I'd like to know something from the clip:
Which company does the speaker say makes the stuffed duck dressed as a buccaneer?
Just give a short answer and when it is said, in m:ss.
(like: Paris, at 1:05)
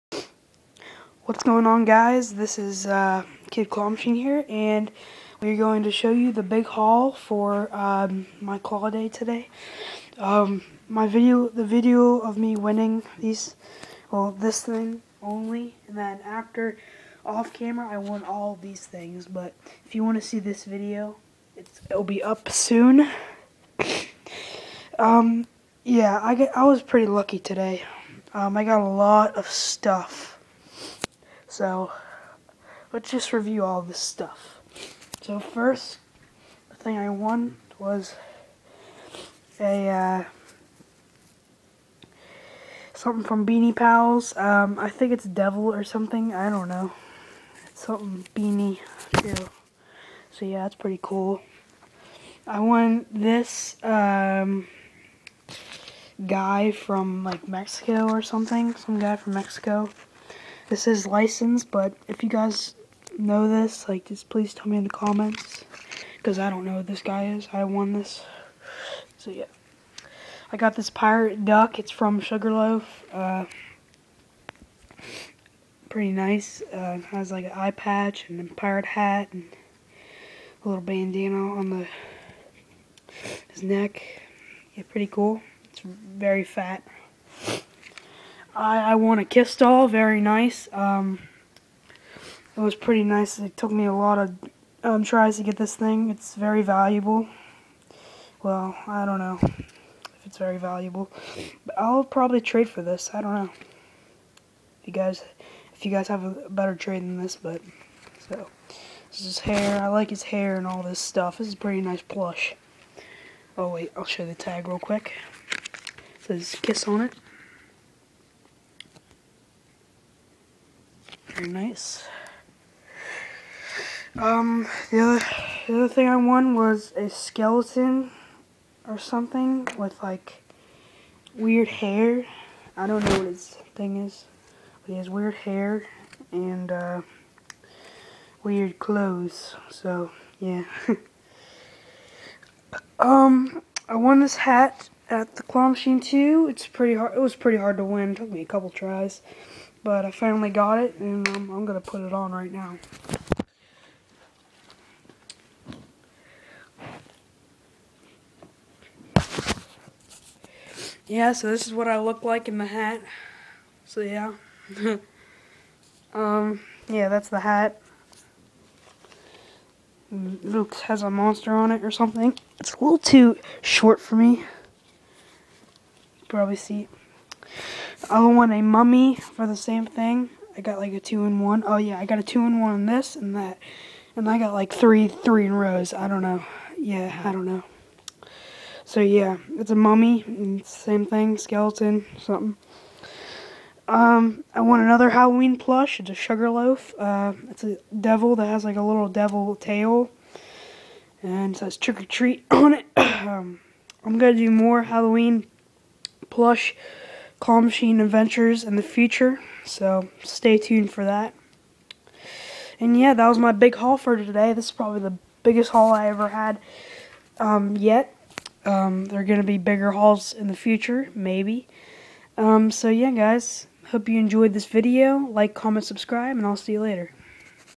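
Sugarloaf, at 1:12.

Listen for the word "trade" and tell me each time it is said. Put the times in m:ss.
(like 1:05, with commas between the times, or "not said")
1:42, 1:46.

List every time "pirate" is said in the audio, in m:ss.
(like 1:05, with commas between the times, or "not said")
1:10, 1:18.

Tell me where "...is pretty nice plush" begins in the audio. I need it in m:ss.
1:51.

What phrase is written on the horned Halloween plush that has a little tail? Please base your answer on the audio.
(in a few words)
Trick or treat.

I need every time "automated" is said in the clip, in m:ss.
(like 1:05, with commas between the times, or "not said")
not said.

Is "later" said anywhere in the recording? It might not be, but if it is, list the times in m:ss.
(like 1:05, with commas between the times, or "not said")
3:46.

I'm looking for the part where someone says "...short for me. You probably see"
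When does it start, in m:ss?
2:53.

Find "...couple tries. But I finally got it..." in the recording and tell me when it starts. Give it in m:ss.
2:28.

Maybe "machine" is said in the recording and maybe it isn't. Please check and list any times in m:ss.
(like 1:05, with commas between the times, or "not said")
0:03, 2:25, 3:27.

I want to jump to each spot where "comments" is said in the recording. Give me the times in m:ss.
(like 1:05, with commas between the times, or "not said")
1:04, 3:45.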